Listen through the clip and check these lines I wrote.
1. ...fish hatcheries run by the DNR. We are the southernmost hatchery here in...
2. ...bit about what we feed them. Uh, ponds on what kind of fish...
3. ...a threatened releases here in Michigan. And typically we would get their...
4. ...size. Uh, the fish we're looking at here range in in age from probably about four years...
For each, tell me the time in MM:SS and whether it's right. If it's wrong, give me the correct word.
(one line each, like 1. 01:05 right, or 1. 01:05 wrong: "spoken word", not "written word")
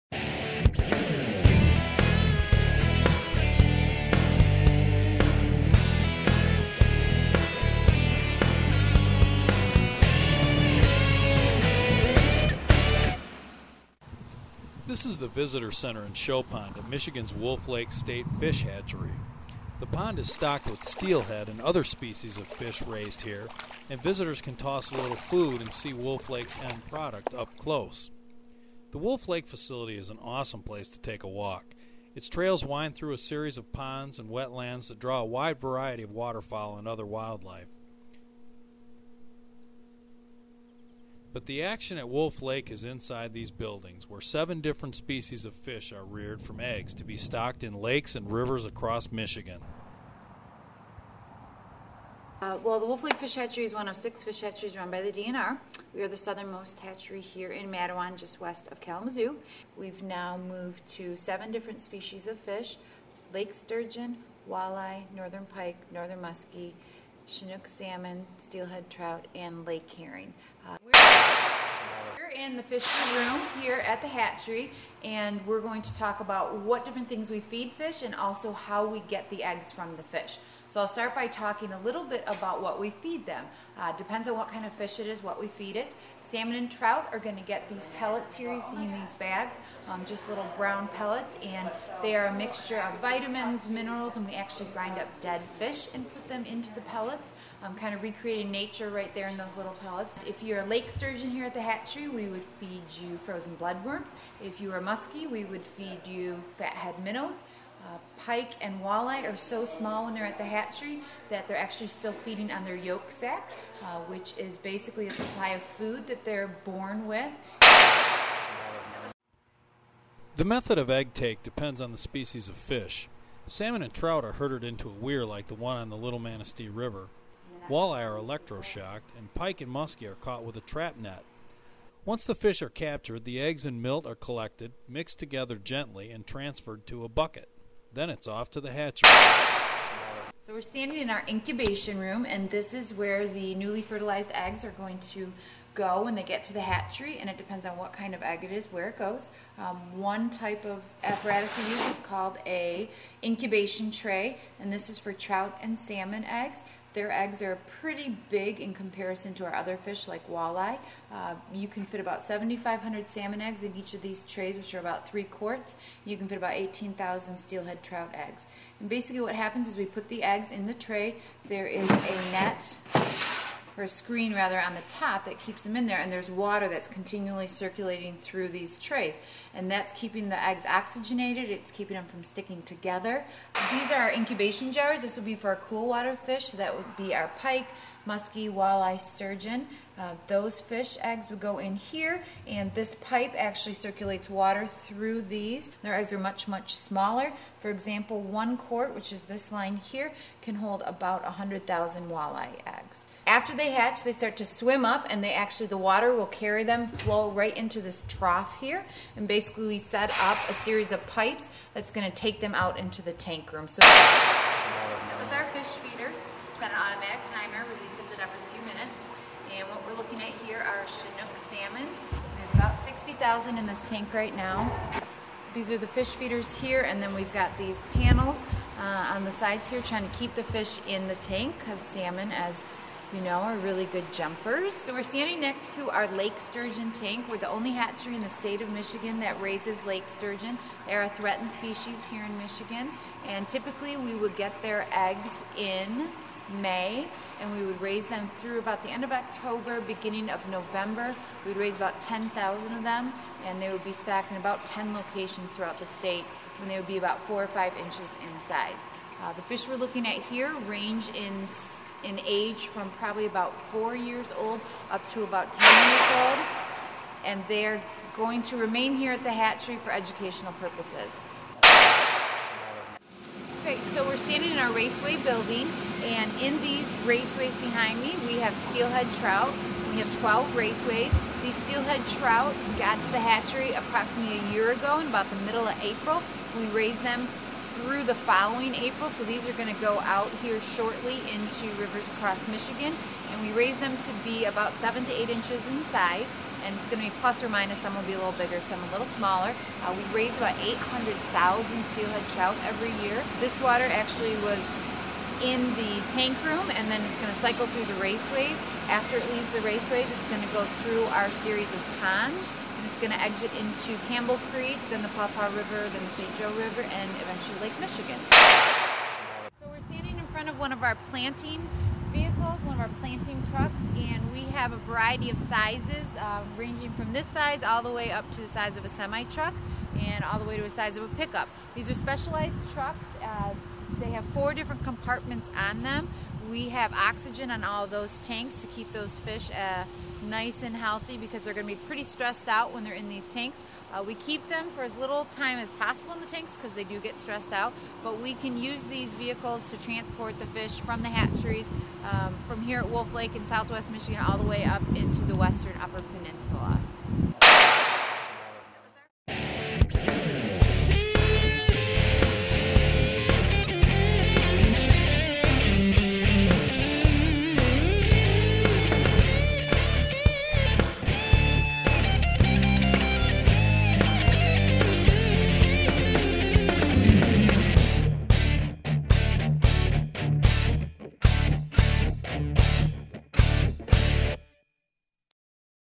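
1. 00:54 right
2. 01:22 wrong: "depends", not "ponds"
3. 04:01 wrong: "species", not "releases"
4. 04:18 right.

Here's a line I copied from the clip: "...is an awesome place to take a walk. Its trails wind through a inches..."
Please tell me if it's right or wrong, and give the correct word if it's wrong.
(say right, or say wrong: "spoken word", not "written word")
wrong: "series", not "inches".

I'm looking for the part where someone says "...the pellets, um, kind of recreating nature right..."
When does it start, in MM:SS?
01:36.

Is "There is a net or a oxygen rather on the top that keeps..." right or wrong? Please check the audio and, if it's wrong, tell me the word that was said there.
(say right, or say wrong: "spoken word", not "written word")
wrong: "screen", not "oxygen".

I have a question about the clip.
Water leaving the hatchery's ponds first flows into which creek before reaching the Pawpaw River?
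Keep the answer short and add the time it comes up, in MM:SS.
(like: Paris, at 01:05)
Campbell Creek, at 05:14.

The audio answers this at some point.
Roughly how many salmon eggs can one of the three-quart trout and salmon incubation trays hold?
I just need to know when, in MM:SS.
02:42.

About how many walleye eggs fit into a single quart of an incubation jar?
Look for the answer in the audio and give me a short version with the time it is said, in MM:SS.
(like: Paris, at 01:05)
100,000, at 03:21.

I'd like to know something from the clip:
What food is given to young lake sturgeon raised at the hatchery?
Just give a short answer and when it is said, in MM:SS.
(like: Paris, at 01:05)
Frozen bloodworms, at 01:43.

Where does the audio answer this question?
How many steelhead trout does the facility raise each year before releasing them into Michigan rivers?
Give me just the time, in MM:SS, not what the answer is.
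05:00.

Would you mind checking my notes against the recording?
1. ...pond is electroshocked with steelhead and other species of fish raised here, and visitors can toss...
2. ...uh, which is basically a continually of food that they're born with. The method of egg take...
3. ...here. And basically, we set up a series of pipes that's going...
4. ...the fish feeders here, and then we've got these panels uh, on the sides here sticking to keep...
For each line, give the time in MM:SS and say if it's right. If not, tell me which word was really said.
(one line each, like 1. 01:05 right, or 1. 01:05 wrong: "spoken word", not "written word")
1. 00:19 wrong: "stocked", not "electroshocked"
2. 01:53 wrong: "supply", not "continually"
3. 03:28 right
4. 03:45 wrong: "trying", not "sticking".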